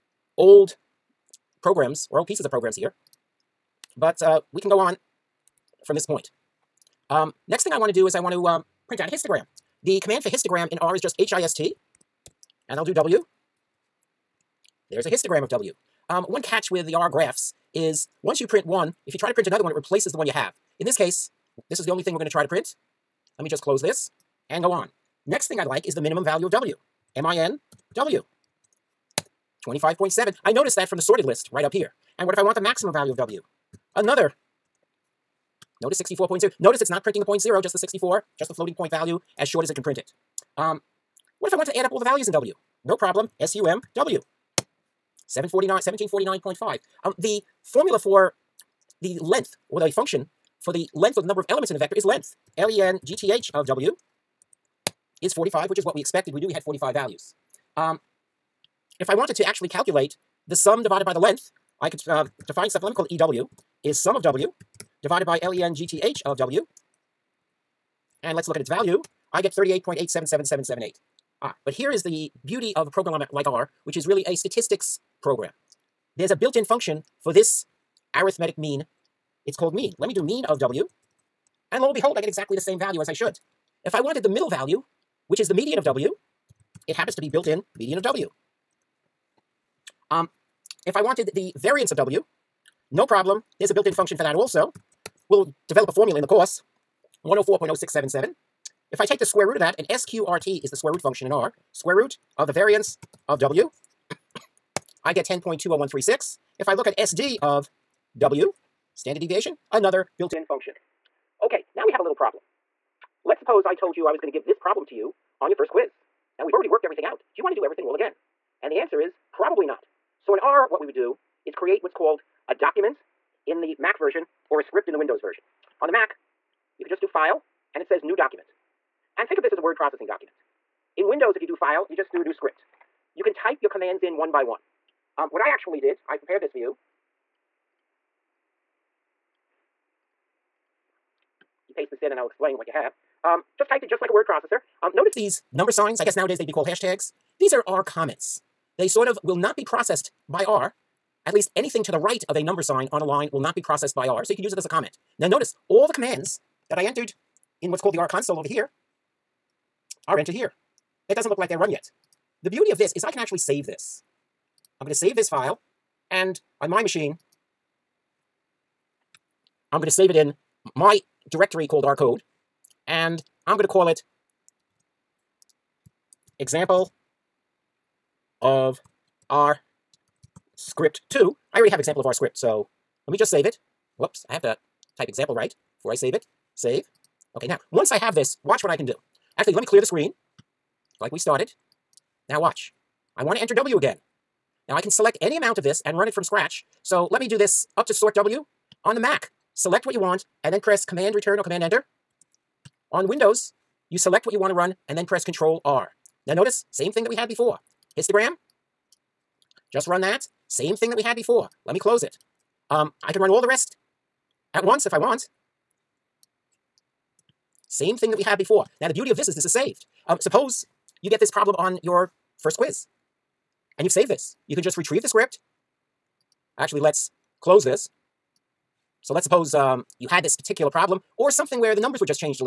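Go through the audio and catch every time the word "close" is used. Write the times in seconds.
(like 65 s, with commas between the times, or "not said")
23 s, 211 s, 227 s.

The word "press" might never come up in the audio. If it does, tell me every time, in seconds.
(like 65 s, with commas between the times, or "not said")
200 s, 205 s.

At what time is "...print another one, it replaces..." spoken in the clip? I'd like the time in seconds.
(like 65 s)
19 s.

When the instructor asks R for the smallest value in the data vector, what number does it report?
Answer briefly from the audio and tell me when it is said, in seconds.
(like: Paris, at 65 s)
25.7, at 29 s.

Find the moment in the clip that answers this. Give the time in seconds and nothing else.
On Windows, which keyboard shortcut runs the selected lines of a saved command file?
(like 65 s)
205 s.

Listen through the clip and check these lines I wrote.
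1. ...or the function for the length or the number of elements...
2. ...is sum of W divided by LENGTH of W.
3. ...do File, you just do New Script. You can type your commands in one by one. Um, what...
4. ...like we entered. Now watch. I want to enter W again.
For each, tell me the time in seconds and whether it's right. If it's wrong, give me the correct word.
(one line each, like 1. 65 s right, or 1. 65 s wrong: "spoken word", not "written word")
1. 49 s right
2. 63 s right
3. 131 s right
4. 191 s wrong: "started", not "entered".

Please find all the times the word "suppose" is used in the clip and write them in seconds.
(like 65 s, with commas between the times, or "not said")
113 s, 220 s, 229 s.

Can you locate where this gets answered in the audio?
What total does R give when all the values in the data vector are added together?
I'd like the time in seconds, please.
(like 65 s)
45 s.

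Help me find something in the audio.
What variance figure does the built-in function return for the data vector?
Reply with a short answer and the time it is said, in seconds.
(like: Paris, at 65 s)
104.0677, at 97 s.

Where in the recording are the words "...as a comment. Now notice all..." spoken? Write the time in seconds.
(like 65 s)
154 s.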